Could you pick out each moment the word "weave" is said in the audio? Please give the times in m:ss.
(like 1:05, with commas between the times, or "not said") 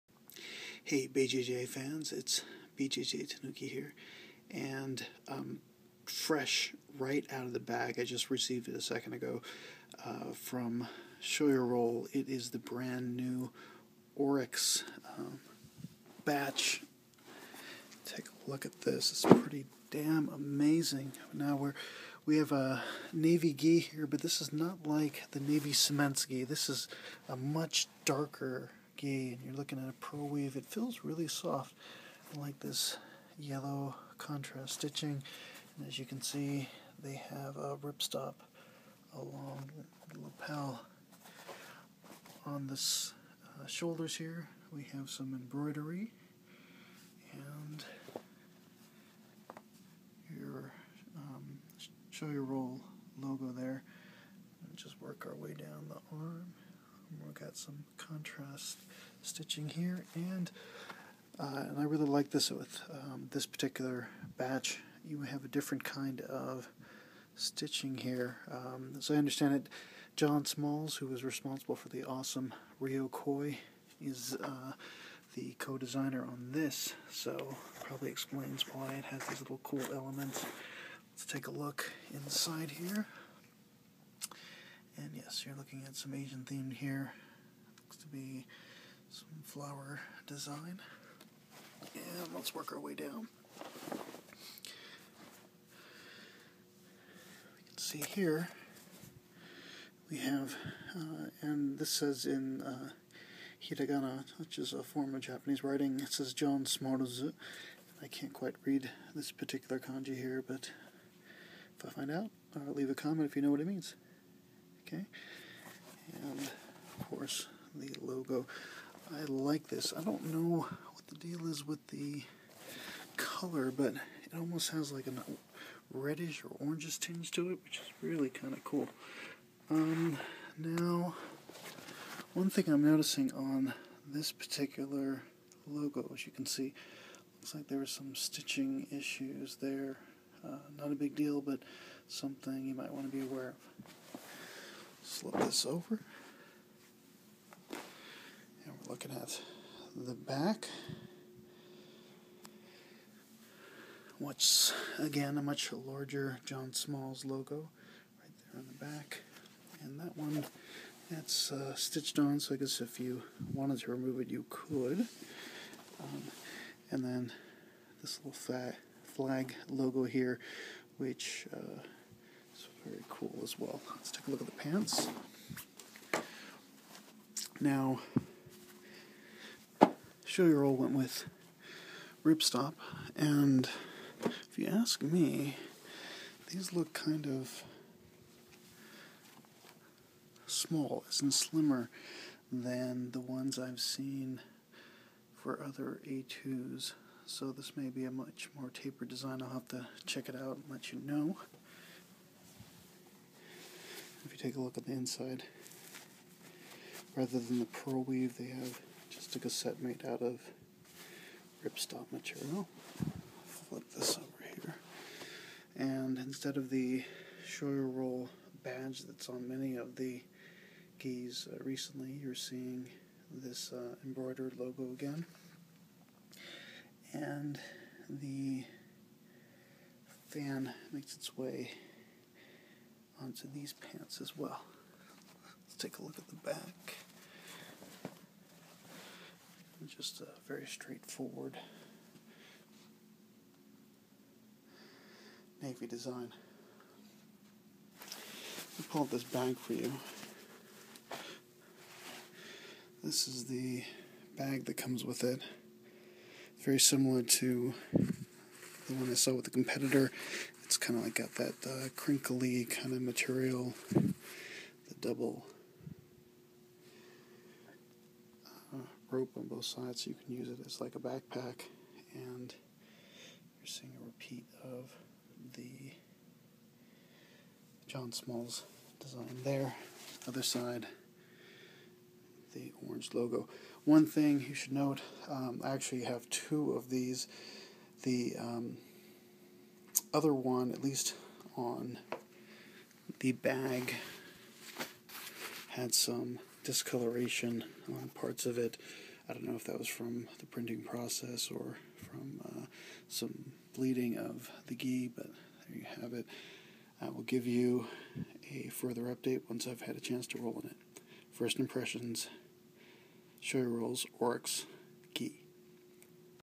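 0:30, 3:28.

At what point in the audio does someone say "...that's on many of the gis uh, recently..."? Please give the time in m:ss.
3:39.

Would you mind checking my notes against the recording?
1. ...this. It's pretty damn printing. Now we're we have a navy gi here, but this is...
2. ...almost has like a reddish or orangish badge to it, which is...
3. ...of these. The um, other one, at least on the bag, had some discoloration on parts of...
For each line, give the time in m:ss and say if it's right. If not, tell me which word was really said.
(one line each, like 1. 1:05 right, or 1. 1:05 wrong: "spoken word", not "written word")
1. 0:18 wrong: "amazing", not "printing"
2. 2:04 wrong: "tinge", not "badge"
3. 4:46 right.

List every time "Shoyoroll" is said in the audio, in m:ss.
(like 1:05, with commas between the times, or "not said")
0:52, 3:00, 3:37.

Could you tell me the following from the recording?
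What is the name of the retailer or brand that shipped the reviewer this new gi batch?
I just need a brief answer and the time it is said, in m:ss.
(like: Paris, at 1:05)
Your Roll, at 0:11.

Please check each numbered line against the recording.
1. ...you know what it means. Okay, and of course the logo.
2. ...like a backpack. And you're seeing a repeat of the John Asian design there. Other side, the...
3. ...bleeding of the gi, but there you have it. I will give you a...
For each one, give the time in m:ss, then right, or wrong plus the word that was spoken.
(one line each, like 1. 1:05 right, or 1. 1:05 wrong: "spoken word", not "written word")
1. 1:53 right
2. 4:30 wrong: "Smalls", not "Asian"
3. 5:03 right.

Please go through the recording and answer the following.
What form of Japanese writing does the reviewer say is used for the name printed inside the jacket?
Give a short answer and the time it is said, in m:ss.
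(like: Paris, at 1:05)
Hiragana, at 1:43.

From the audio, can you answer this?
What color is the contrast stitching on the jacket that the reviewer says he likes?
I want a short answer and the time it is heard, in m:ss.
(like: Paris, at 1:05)
Yellow, at 0:33.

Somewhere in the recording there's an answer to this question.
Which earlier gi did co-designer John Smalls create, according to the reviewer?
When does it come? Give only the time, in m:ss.
1:12.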